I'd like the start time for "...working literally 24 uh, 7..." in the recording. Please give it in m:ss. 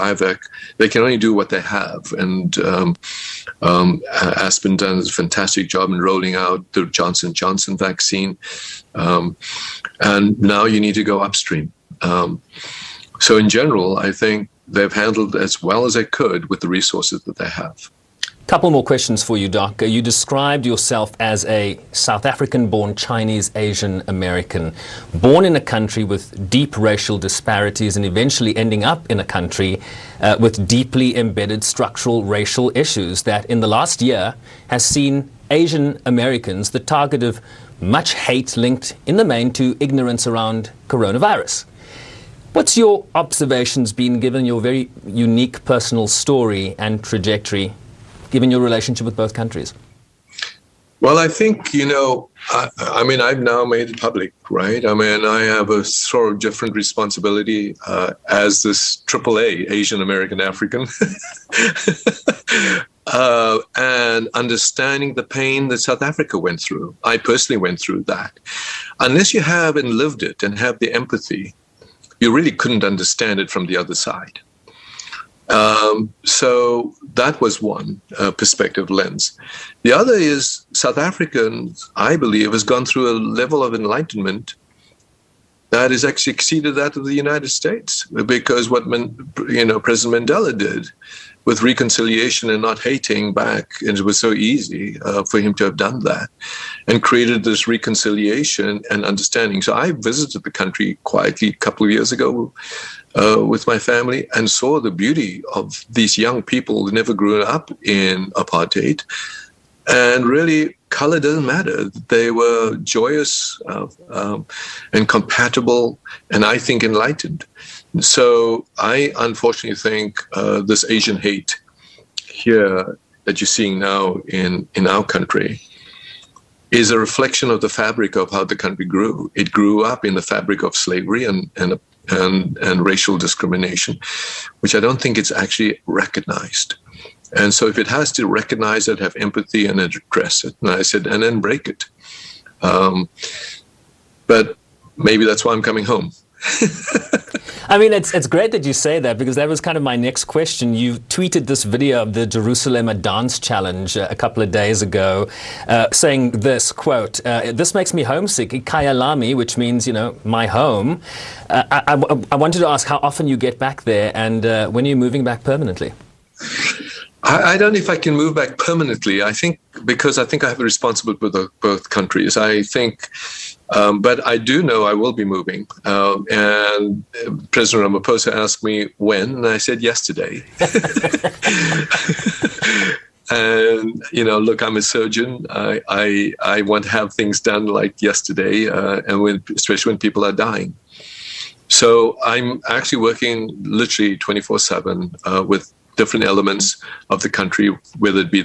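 3:13.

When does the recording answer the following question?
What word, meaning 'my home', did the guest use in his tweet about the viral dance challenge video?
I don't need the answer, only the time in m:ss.
2:38.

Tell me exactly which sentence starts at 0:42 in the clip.
What's your observations been given your very unique personal story and trajectory given your relationship with both countries?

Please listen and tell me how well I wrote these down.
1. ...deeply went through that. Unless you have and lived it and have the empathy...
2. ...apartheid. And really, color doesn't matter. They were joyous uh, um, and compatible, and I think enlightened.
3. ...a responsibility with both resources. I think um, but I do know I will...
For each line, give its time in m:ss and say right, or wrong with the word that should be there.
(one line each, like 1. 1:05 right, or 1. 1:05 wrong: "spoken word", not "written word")
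1. 1:07 wrong: "personally", not "deeply"
2. 1:48 right
3. 2:50 wrong: "countries", not "resources".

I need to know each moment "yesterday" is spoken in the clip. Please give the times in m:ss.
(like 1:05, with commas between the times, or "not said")
2:59, 3:08.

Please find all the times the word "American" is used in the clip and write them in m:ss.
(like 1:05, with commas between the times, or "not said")
0:24, 0:36, 1:00.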